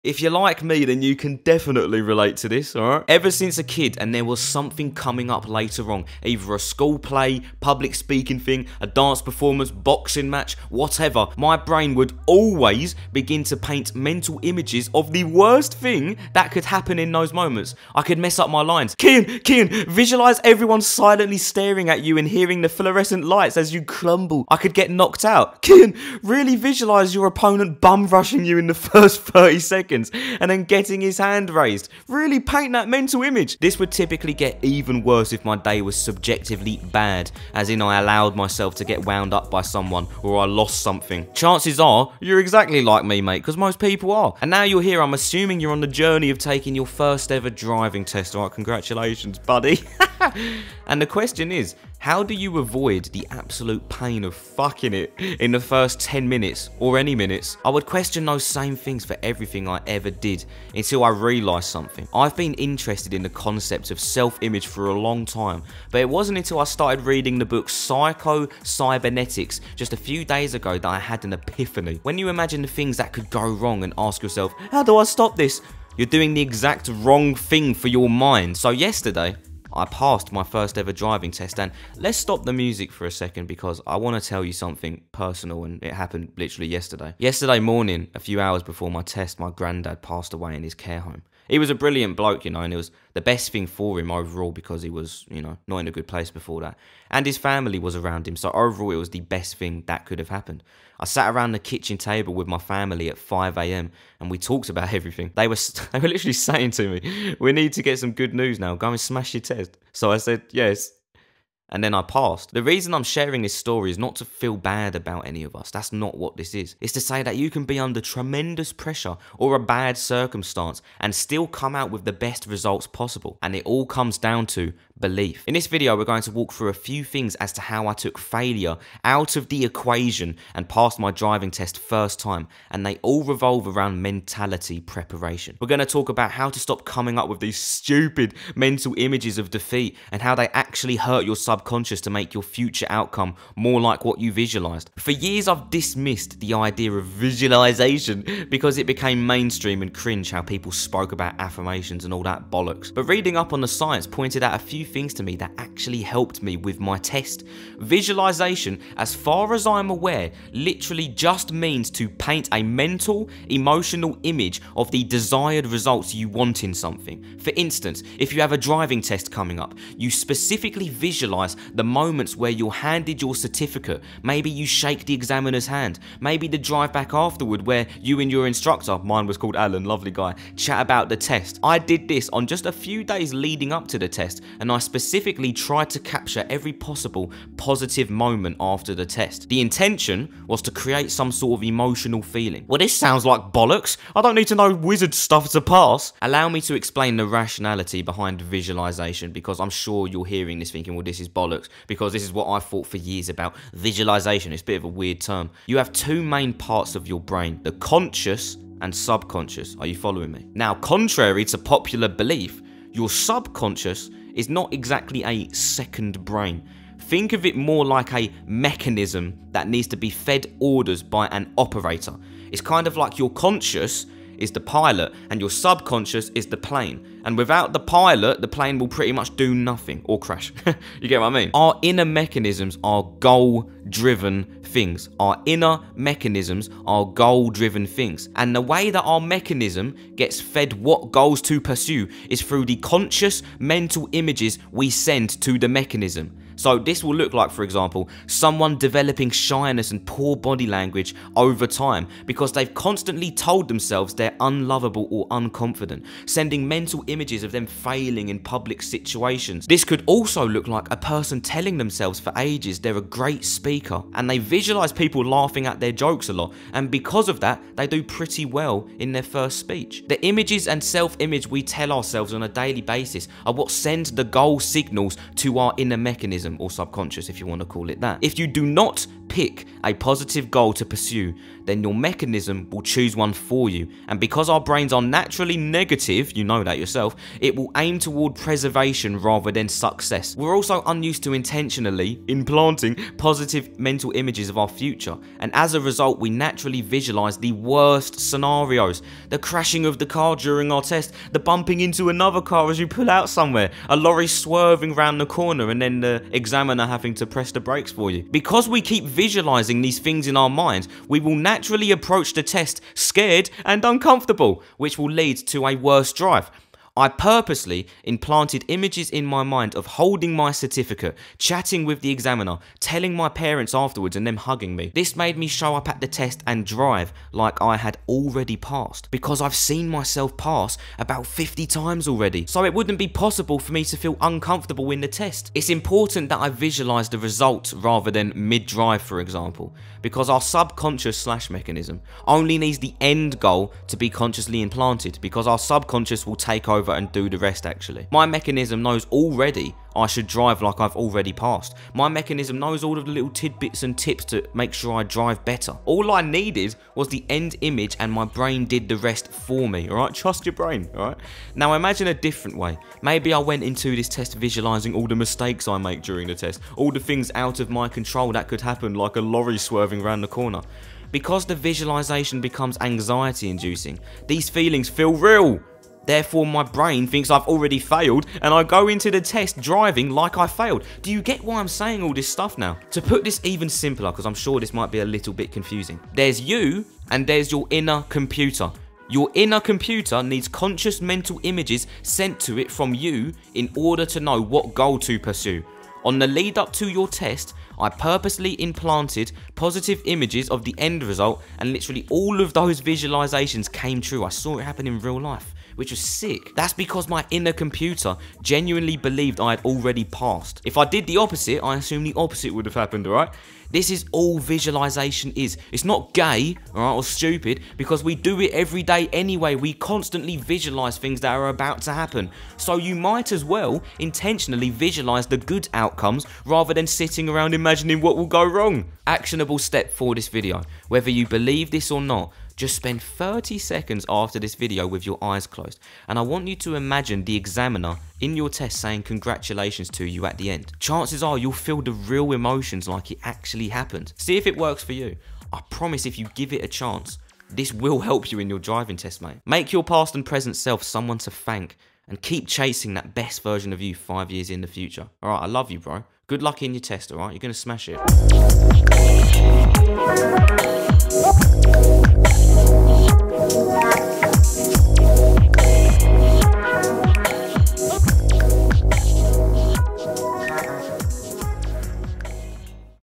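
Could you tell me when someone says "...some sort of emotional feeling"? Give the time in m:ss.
3:11.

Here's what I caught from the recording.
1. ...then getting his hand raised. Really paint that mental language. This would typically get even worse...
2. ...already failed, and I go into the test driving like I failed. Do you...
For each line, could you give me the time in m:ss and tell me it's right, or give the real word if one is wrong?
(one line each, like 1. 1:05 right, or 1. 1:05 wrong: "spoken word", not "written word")
1. 0:30 wrong: "image", not "language"
2. 6:17 right.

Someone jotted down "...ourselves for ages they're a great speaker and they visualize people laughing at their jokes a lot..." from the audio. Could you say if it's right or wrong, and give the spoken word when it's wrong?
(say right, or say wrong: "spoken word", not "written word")
wrong: "themselves", not "ourselves".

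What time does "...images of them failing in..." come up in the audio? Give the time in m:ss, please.
4:17.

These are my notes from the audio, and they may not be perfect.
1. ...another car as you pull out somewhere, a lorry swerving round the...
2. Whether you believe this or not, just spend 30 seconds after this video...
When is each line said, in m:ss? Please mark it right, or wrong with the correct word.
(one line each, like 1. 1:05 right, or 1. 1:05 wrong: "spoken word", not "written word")
1. 5:02 right
2. 7:10 right.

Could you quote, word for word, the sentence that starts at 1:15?
You're doing the exact wrong thing for your mind.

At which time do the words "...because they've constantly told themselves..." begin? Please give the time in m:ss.
4:12.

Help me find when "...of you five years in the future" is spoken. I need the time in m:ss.
7:33.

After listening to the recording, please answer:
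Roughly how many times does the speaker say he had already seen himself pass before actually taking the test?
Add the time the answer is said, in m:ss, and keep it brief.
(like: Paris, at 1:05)
50, at 5:31.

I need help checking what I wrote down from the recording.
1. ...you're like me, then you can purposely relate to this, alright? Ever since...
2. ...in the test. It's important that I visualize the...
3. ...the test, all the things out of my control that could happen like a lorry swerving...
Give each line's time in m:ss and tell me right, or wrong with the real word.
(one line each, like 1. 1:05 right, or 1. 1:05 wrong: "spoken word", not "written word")
1. 0:00 wrong: "definitely", not "purposely"
2. 5:34 right
3. 6:06 right.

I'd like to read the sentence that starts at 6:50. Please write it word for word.
If I did the opposite, I assume the opposite would have happened, alright?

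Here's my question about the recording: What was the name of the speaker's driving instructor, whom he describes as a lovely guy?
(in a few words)
Alan.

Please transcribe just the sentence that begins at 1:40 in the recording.
I sat around the kitchen table with my family at 5 a.m.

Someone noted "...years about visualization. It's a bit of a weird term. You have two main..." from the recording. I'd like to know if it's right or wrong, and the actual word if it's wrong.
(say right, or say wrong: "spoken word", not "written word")
right.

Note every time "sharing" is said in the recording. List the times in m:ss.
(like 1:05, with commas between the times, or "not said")
1:53.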